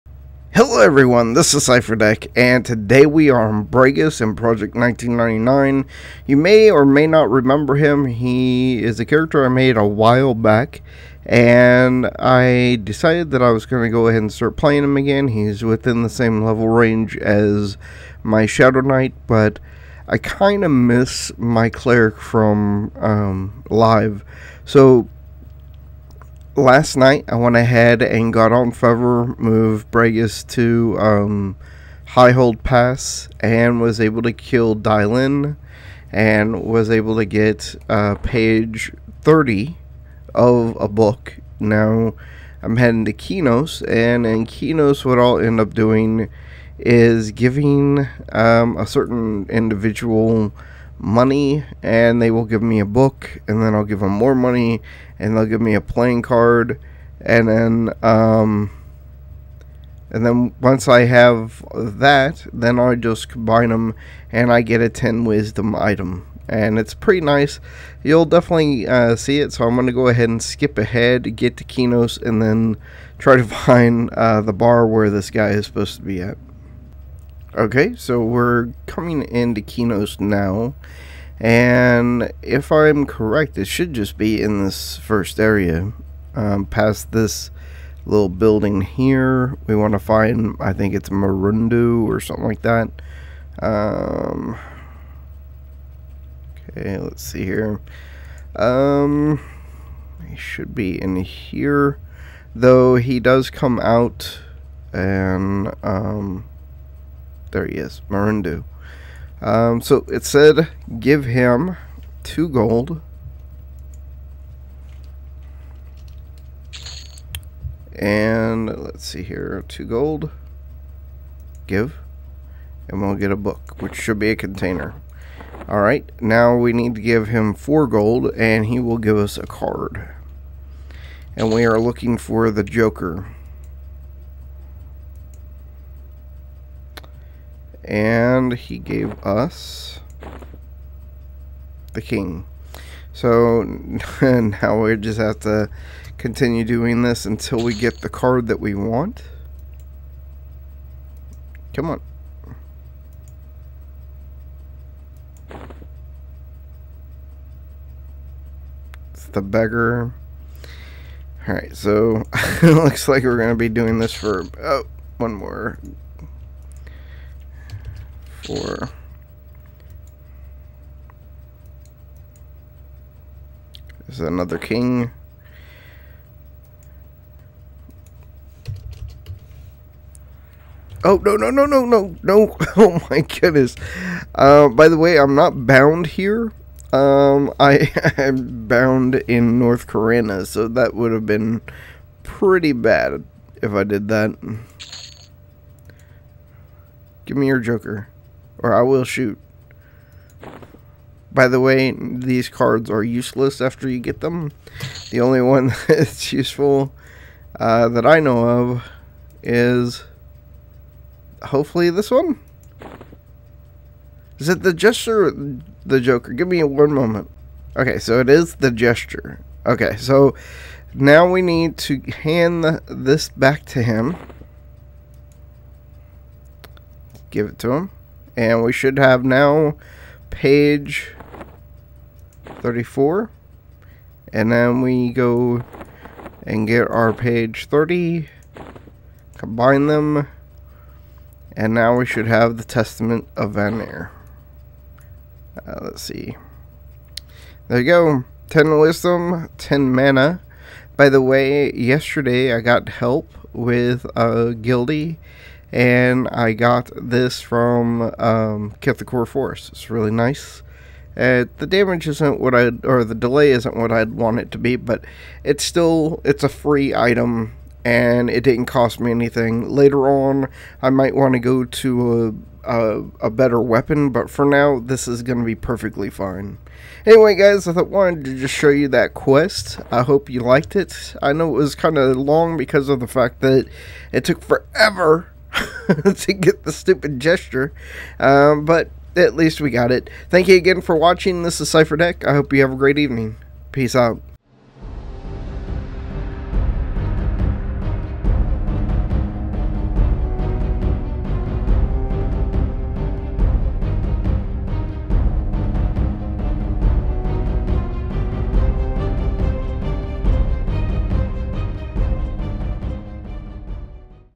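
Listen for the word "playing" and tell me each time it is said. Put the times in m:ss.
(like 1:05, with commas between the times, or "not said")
0:14, 0:55.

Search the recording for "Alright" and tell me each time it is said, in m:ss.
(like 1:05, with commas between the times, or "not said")
2:05, 2:41.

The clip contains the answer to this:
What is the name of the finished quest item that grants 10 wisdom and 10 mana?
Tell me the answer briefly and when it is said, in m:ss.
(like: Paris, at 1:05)
Testament of Vanear, at 4:02.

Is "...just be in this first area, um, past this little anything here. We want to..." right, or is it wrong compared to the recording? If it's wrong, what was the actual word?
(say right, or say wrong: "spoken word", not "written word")
wrong: "building", not "anything".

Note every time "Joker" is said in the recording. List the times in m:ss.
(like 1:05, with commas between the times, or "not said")
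2:12, 3:17, 3:36.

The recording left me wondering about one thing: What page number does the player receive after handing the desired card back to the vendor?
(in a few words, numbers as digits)
34.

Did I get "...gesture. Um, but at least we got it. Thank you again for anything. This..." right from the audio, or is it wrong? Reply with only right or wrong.
wrong.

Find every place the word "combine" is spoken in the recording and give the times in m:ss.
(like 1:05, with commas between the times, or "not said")
1:03, 3:59.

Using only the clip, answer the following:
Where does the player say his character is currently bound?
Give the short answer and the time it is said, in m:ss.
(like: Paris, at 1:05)
North Karana, at 3:09.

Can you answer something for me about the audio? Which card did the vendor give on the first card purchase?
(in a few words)
the king.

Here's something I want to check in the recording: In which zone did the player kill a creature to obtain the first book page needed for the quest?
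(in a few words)
High Hold Pass.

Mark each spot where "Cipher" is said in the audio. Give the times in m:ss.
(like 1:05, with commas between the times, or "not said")
0:01, 4:51.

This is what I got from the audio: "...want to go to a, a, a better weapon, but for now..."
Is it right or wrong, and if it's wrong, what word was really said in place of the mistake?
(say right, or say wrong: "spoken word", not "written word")
right.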